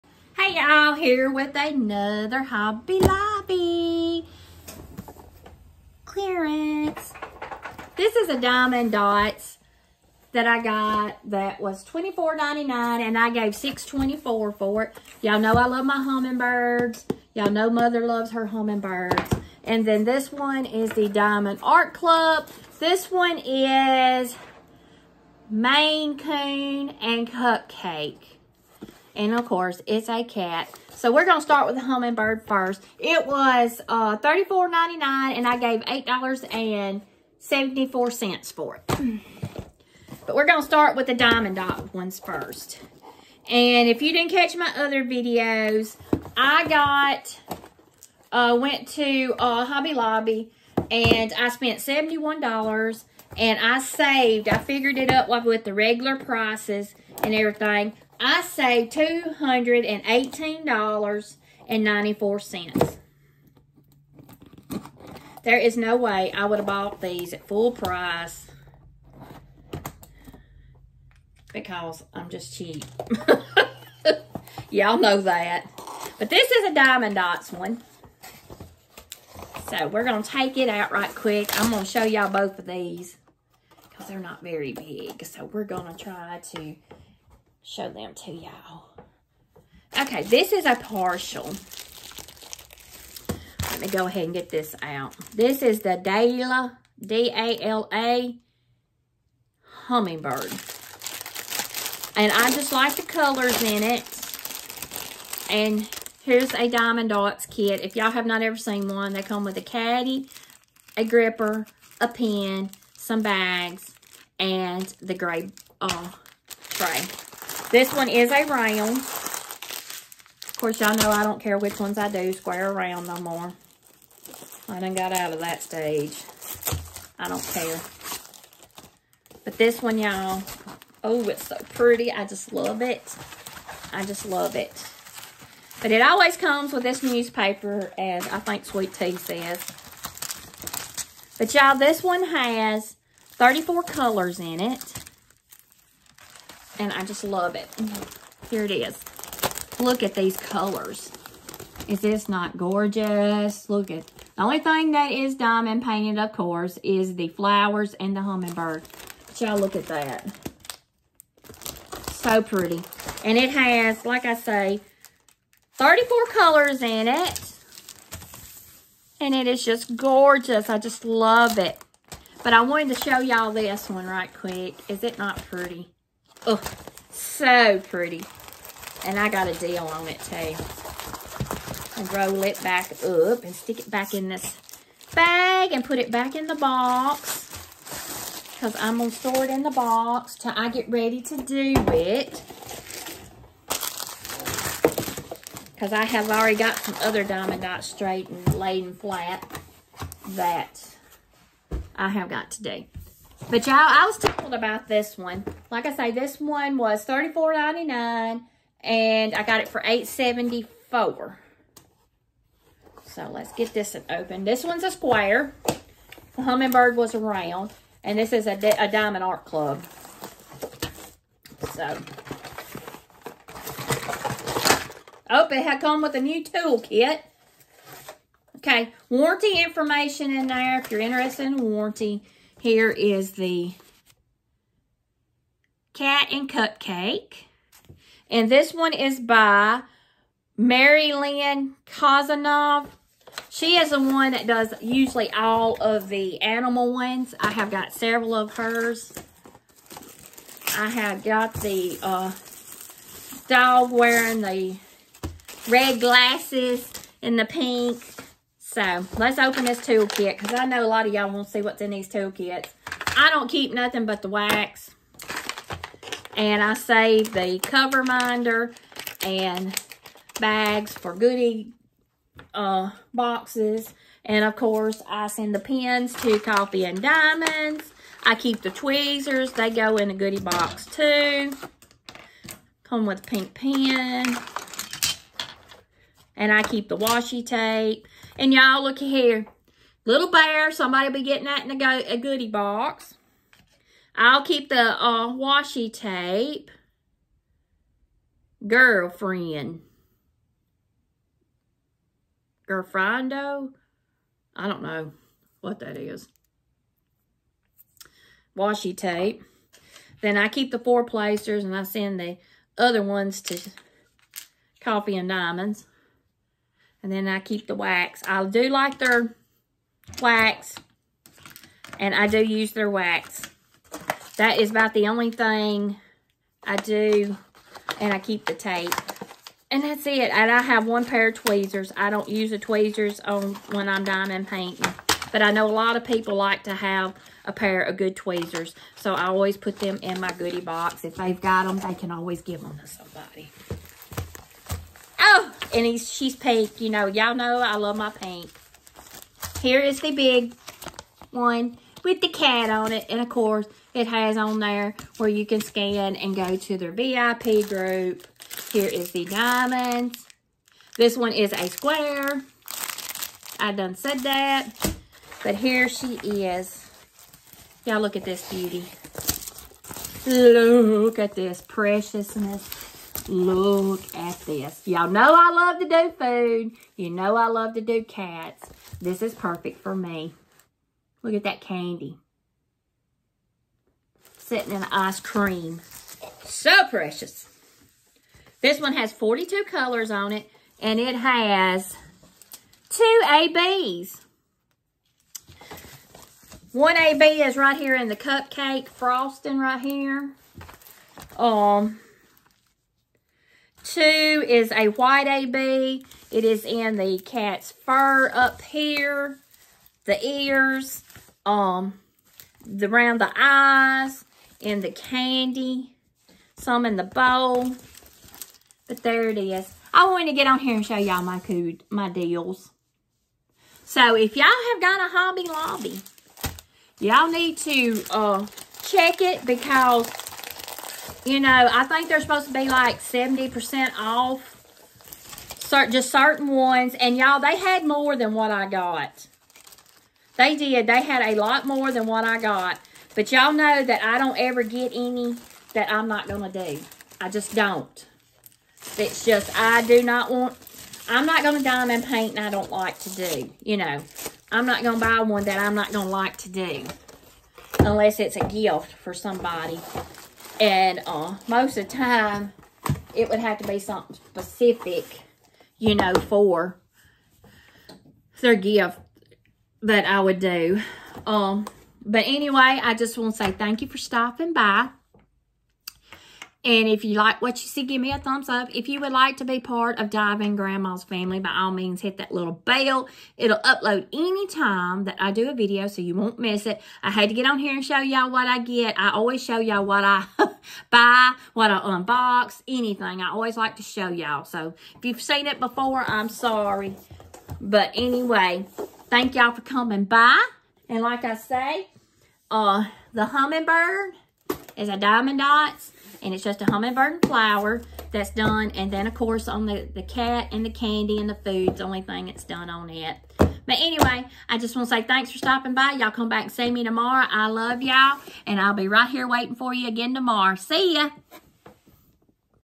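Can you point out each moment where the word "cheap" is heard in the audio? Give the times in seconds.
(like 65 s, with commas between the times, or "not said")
72 s.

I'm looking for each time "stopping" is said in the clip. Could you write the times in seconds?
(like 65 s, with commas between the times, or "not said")
473 s, 515 s.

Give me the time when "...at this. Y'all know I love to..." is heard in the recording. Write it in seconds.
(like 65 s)
374 s.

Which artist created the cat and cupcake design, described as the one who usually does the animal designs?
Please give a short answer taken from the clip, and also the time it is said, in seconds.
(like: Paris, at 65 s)
Mary Lynn Kozanov, at 240 s.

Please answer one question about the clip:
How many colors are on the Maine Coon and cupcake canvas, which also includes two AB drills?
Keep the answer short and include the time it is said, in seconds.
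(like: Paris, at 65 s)
42, at 389 s.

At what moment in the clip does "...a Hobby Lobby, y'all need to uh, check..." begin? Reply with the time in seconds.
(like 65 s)
425 s.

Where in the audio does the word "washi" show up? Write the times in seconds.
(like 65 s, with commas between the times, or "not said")
286 s, 295 s, 308 s.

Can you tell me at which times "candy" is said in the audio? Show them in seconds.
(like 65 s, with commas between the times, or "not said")
381 s, 414 s, 510 s.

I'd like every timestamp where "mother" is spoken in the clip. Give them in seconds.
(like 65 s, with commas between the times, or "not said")
17 s.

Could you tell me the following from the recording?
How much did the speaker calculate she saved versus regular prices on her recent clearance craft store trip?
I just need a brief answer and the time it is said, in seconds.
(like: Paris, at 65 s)
$218.94, at 58 s.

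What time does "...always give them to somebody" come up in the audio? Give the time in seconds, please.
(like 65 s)
342 s.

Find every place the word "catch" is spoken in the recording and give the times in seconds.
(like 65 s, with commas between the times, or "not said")
44 s.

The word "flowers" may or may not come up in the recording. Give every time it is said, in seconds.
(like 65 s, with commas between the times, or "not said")
157 s, 507 s.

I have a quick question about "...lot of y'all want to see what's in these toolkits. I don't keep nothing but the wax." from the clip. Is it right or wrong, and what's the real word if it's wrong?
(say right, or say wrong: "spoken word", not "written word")
right.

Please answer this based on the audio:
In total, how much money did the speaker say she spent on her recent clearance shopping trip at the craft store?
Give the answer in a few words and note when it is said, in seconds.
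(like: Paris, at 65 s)
$71, at 51 s.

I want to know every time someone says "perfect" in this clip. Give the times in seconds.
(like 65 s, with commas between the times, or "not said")
379 s.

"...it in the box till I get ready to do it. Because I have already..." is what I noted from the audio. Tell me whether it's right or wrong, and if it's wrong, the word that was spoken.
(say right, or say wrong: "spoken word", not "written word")
right.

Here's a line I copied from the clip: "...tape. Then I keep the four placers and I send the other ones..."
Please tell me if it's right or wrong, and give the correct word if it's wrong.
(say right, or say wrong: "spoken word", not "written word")
right.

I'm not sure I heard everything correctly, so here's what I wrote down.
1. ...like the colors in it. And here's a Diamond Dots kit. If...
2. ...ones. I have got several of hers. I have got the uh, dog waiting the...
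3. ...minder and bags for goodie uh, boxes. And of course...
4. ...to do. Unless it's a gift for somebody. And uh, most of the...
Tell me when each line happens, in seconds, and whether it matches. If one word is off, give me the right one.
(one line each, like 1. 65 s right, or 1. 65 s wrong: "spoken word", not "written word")
1. 102 s right
2. 246 s wrong: "wearing", not "waiting"
3. 268 s right
4. 456 s right.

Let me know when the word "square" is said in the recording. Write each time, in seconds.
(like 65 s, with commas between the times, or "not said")
122 s, 214 s, 361 s.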